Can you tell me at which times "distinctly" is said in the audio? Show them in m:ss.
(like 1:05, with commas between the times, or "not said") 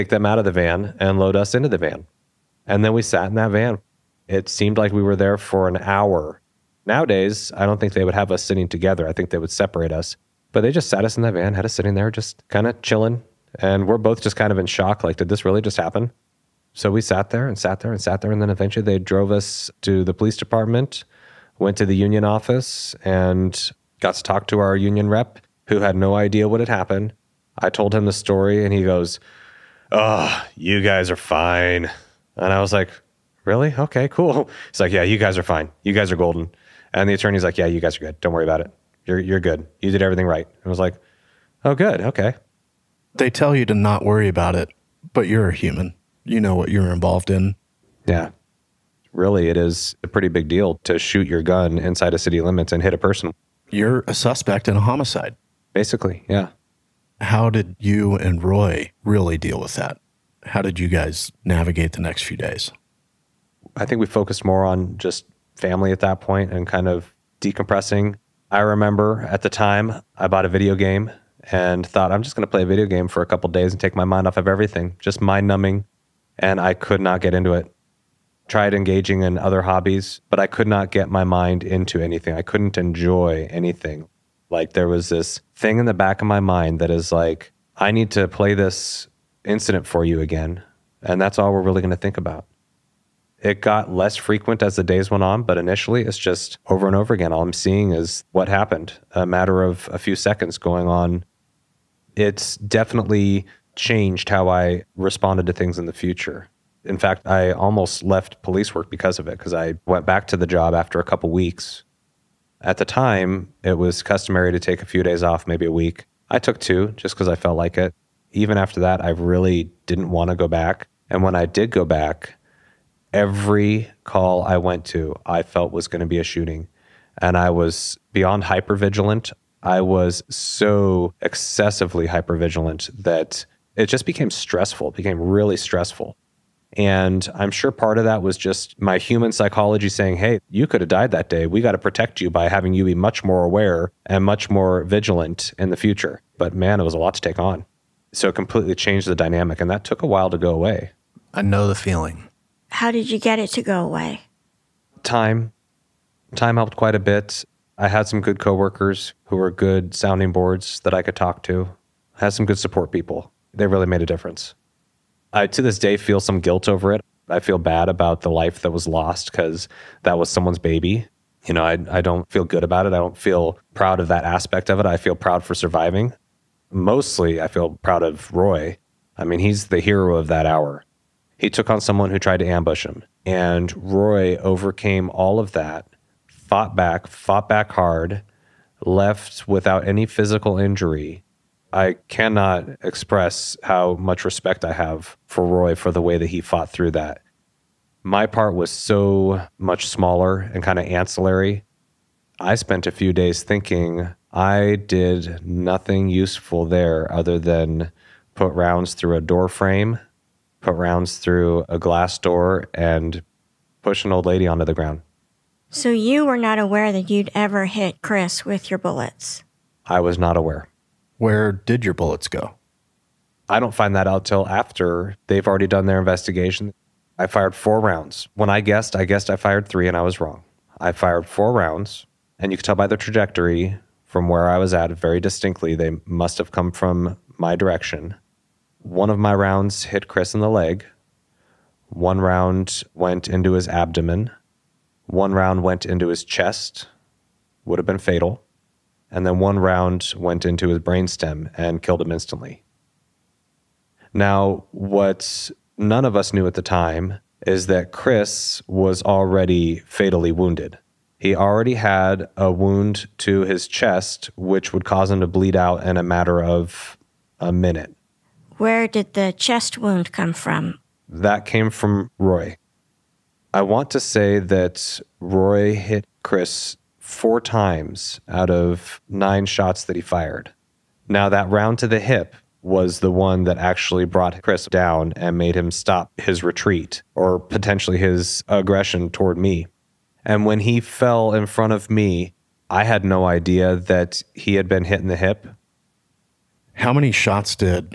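3:55.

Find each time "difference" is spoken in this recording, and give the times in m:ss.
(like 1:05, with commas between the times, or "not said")
2:44.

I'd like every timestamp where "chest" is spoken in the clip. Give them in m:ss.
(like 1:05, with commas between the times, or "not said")
4:06, 4:23, 4:29.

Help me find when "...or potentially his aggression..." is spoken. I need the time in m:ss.
4:47.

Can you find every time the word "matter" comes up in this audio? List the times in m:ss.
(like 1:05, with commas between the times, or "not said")
1:39, 4:26.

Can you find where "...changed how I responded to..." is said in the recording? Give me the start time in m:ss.
1:43.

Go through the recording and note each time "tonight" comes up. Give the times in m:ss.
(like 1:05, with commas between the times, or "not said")
not said.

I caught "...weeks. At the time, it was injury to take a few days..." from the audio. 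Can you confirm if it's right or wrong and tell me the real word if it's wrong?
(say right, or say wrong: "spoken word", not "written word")
wrong: "customary", not "injury".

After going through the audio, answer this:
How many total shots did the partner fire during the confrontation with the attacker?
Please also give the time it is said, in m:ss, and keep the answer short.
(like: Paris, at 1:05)
9, at 4:39.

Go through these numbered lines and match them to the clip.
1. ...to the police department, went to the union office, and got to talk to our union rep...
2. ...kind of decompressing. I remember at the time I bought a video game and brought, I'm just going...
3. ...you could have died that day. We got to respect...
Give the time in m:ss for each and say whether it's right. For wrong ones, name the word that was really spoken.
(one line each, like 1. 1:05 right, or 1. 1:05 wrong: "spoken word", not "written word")
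1. 0:19 right
2. 1:06 wrong: "thought", not "brought"
3. 2:20 wrong: "protect", not "respect".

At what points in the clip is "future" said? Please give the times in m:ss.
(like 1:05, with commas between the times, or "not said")
1:45, 2:25.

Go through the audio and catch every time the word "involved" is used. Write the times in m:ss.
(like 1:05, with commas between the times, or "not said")
0:46.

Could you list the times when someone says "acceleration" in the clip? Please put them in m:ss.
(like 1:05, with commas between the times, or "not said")
not said.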